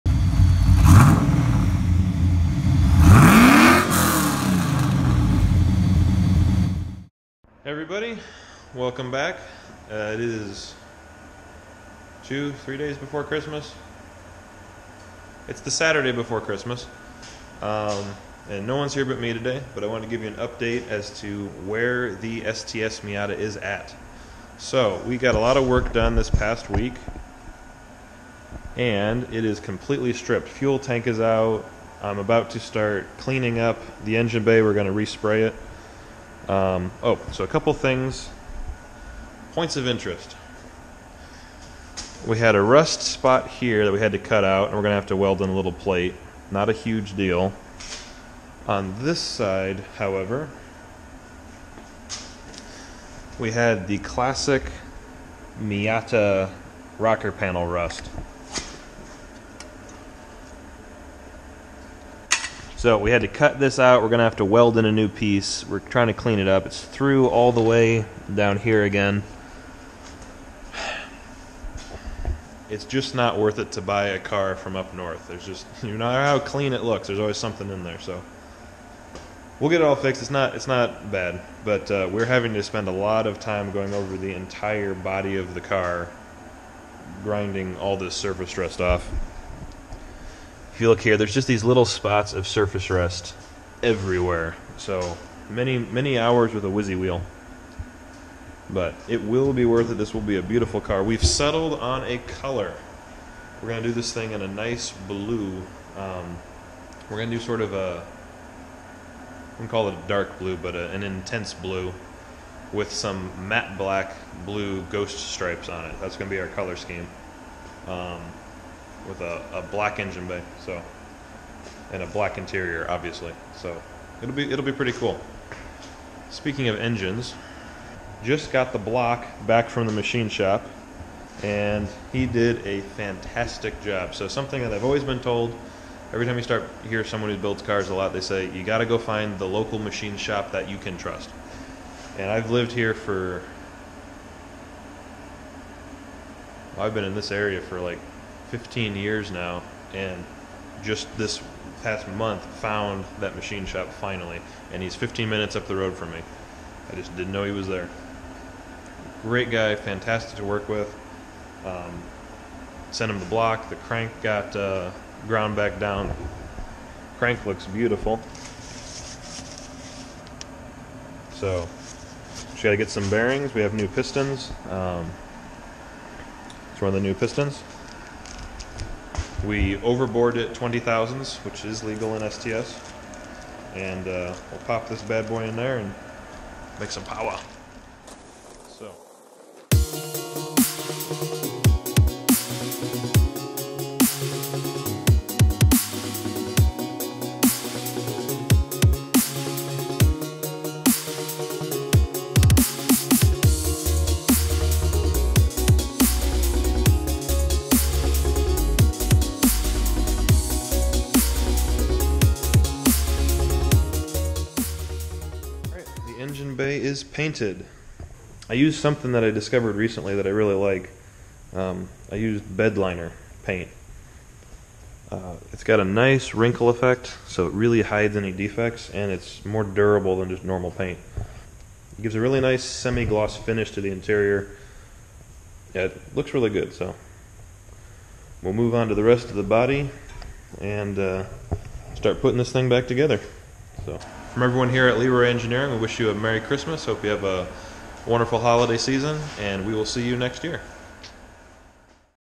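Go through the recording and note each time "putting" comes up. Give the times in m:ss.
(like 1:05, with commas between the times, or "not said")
4:02.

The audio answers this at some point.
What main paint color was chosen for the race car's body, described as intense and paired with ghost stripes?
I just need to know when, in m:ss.
1:50.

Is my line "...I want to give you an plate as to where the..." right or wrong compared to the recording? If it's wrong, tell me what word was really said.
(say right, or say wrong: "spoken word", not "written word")
wrong: "update", not "plate".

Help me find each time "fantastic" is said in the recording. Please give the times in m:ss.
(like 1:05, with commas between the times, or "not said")
2:12, 2:39.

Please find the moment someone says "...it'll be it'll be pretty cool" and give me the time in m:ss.
2:04.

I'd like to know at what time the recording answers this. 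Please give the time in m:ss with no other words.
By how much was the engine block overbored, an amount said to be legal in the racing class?
3:00.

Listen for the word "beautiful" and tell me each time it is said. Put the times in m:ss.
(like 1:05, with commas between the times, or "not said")
1:40, 2:47.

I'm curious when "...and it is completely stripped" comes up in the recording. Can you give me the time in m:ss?
0:28.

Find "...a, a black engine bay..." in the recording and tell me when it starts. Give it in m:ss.
1:59.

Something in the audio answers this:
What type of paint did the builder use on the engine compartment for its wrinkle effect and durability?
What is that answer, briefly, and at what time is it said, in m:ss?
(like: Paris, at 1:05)
Bedliner paint, at 3:42.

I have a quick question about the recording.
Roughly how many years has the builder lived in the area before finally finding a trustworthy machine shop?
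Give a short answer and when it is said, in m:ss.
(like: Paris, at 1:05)
15, at 2:28.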